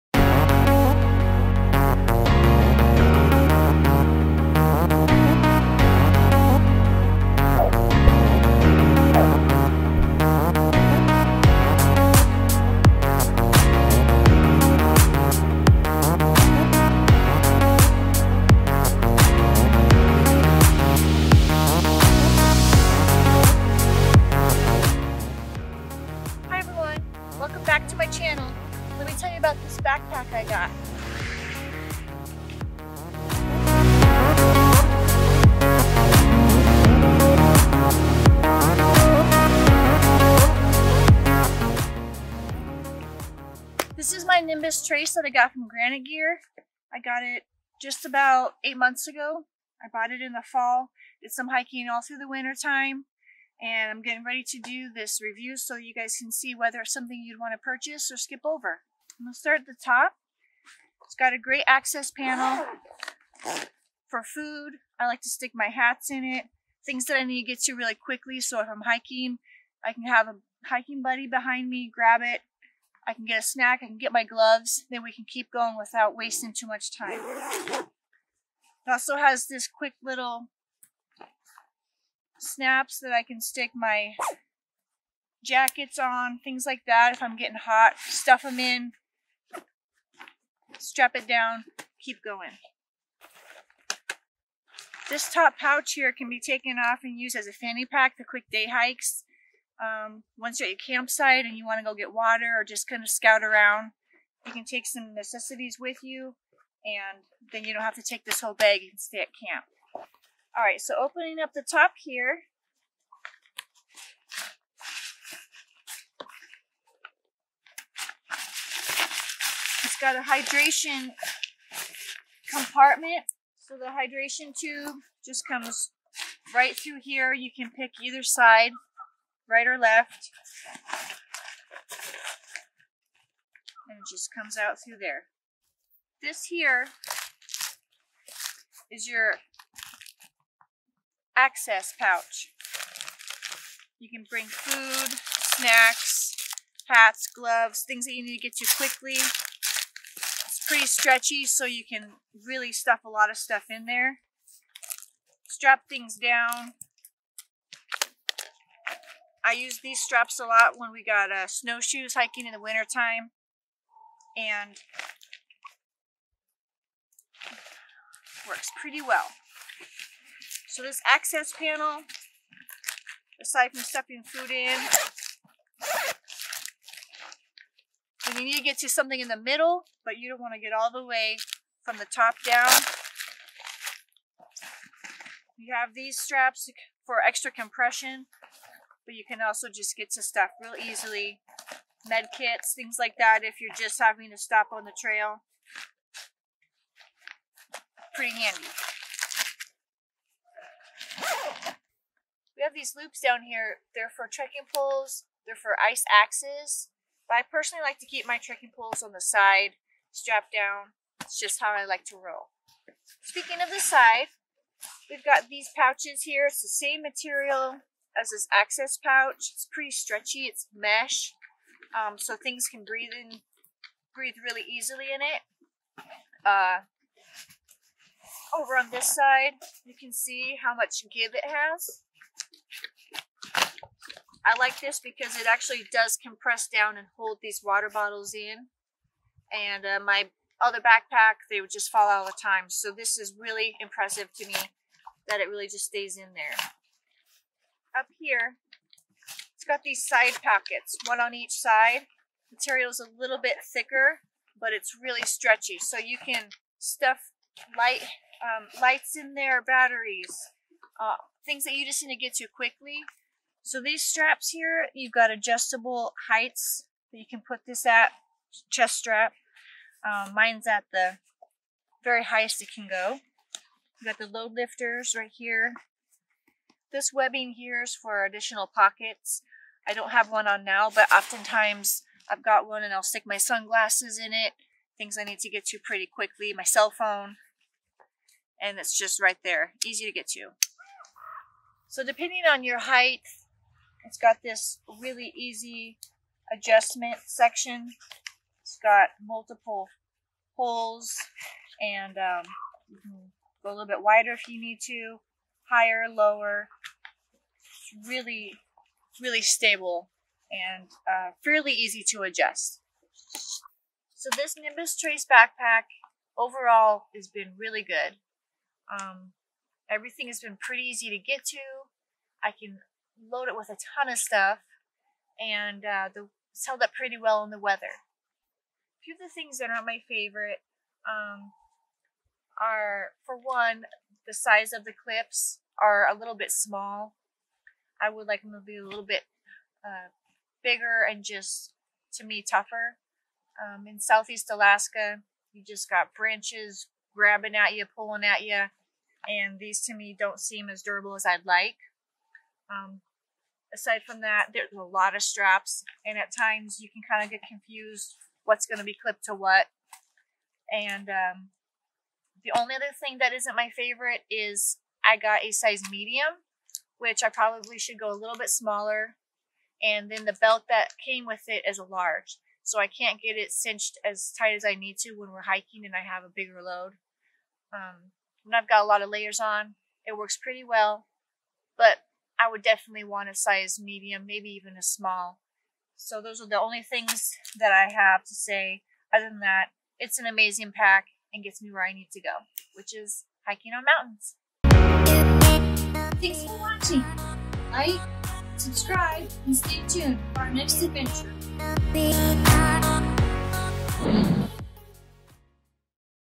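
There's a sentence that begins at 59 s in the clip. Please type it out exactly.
I'm going to start at the top.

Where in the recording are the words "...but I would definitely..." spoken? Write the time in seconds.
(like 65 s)
381 s.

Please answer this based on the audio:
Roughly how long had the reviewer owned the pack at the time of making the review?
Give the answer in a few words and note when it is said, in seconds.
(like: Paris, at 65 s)
8 months, at 48 s.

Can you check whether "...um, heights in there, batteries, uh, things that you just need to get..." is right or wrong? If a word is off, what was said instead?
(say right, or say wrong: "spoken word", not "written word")
wrong: "lights", not "heights".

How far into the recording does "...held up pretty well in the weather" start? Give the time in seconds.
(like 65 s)
326 s.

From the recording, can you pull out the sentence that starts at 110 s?
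All right, so opening up the top here.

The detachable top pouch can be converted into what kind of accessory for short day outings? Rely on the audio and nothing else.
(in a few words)
fanny pack.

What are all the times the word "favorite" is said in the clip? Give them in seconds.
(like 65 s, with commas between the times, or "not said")
330 s, 363 s.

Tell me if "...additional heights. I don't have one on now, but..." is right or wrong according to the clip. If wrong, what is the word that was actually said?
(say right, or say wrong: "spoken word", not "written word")
wrong: "pockets", not "heights".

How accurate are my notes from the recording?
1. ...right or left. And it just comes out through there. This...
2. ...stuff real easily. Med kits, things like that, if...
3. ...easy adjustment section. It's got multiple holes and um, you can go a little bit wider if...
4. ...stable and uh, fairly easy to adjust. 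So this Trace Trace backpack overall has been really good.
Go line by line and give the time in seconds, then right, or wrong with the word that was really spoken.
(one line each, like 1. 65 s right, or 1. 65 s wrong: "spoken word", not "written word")
1. 129 s right
2. 190 s right
3. 295 s right
4. 309 s wrong: "Nimbus", not "Trace".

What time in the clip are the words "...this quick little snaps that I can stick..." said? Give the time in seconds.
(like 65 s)
79 s.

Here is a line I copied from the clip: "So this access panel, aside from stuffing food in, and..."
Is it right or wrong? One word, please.
right.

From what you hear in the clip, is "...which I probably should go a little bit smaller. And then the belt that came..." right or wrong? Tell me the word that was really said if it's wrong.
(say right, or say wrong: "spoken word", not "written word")
right.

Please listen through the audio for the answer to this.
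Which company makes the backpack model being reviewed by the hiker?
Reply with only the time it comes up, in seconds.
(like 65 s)
45 s.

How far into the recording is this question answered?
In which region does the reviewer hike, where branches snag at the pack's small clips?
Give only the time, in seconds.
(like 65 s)
343 s.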